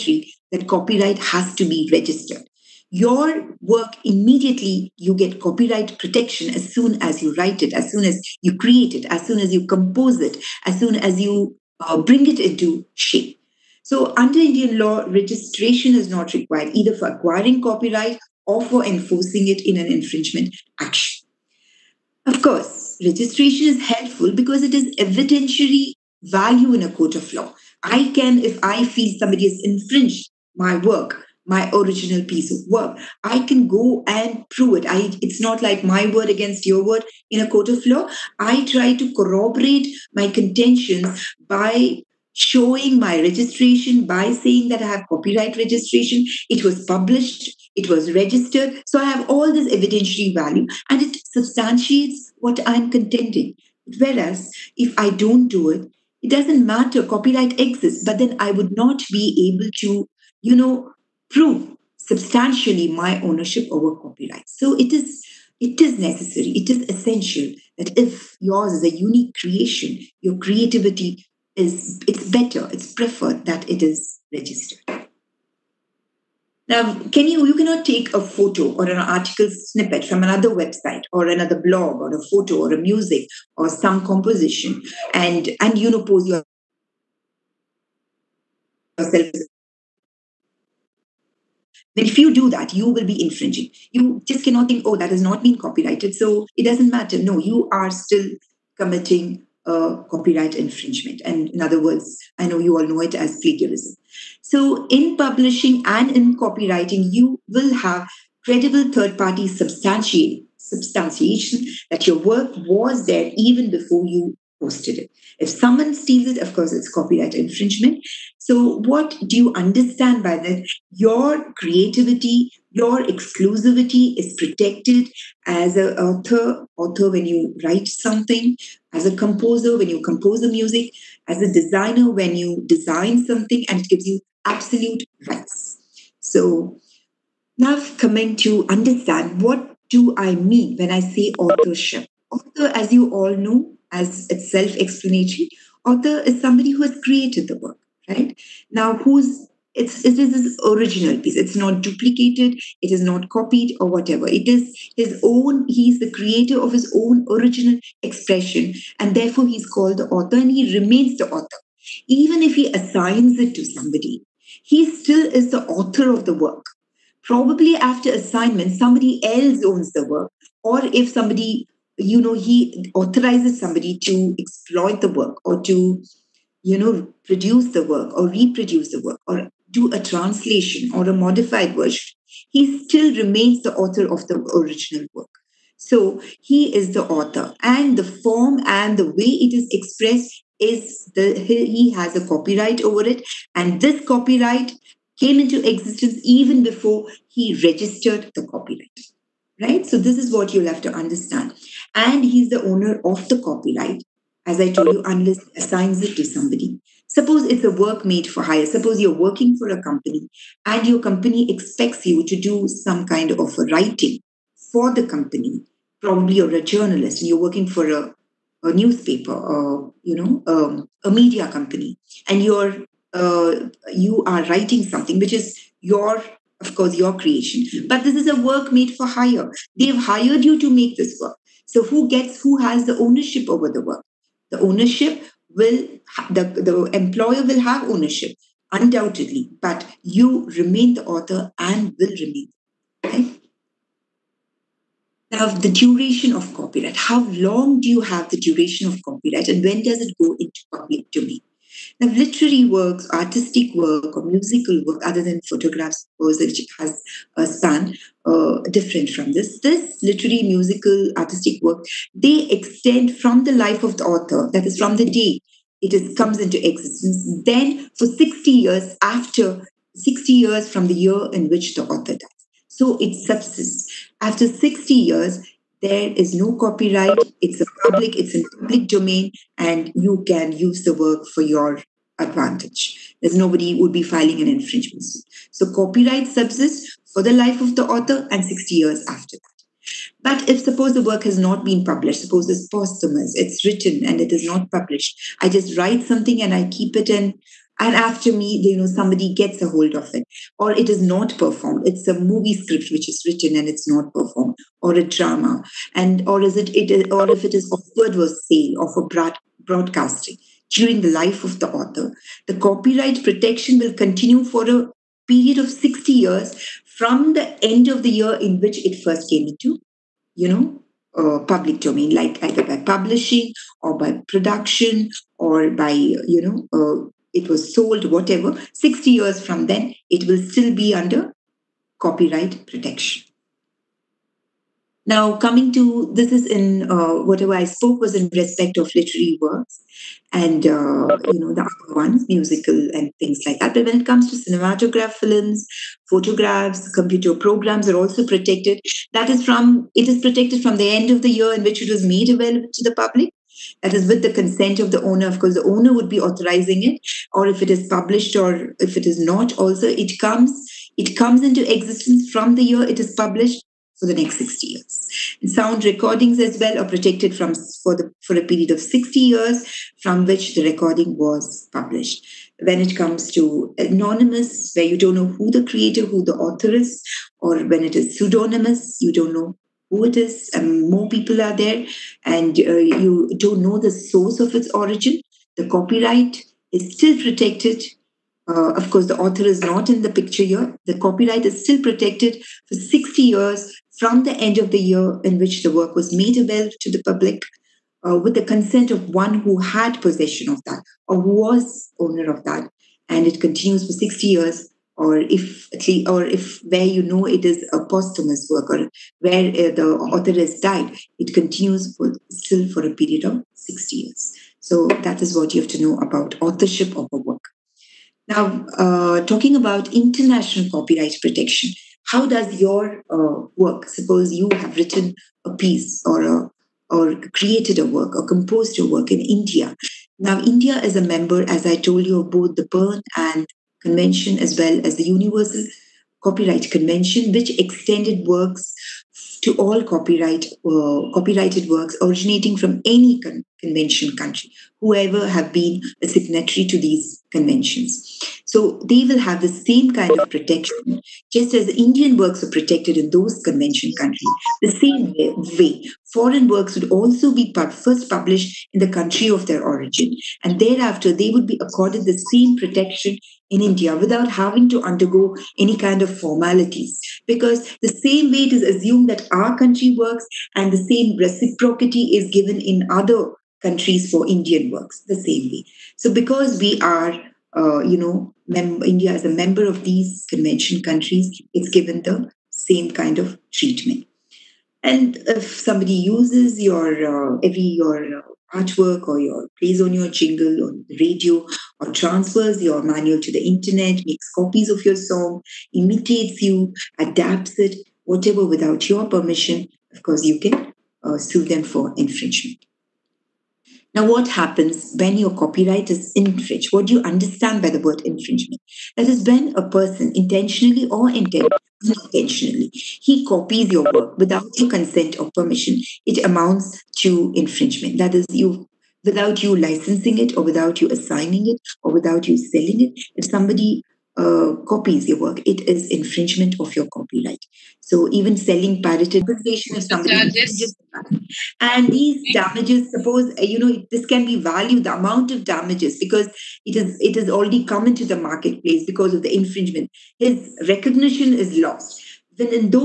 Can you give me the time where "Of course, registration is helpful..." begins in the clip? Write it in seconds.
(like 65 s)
22 s.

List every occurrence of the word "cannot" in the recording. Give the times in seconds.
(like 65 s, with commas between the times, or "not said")
77 s, 94 s.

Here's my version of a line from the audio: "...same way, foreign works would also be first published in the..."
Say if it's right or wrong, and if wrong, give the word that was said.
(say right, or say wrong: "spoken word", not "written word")
right.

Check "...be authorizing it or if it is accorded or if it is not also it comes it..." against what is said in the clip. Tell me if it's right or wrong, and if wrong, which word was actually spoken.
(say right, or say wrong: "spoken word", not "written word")
wrong: "published", not "accorded".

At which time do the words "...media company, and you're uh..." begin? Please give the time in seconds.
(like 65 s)
221 s.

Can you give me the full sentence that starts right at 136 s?
So now coming to understand what do I mean when I say authorship.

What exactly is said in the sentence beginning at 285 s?
So copyright subsists for the life of the author and 60 years after that.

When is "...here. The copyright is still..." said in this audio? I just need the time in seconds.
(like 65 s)
390 s.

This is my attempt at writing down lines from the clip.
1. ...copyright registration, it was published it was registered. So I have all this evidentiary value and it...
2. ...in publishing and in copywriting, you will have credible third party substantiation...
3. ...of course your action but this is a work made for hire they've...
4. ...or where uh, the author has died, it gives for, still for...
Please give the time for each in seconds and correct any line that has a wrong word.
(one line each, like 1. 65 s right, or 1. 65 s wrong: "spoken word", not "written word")
1. 45 s right
2. 104 s right
3. 226 s wrong: "creation", not "action"
4. 408 s wrong: "continues", not "gives".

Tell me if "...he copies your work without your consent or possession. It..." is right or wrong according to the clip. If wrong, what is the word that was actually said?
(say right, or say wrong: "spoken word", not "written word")
wrong: "permission", not "possession".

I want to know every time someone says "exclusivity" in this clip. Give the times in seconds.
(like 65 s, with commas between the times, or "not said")
123 s.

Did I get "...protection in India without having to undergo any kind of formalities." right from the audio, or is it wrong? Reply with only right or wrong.
right.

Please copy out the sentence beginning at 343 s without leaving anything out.
But when it comes to cinematograph films, photographs, computer programs are also protected.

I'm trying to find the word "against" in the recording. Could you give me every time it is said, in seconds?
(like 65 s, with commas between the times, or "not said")
36 s.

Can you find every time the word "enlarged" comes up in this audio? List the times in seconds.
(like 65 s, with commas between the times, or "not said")
not said.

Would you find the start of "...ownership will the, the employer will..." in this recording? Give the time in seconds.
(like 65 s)
234 s.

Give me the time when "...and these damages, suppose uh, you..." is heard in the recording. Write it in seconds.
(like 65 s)
531 s.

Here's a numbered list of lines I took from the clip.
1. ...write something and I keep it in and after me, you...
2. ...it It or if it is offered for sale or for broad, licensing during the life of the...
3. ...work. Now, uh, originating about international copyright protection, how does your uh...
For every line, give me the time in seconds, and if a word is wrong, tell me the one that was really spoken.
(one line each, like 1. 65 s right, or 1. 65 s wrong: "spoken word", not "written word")
1. 295 s right
2. 306 s wrong: "broadcasting", not "licensing"
3. 417 s wrong: "talking", not "originating".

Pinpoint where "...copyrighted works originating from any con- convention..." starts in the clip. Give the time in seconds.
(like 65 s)
441 s.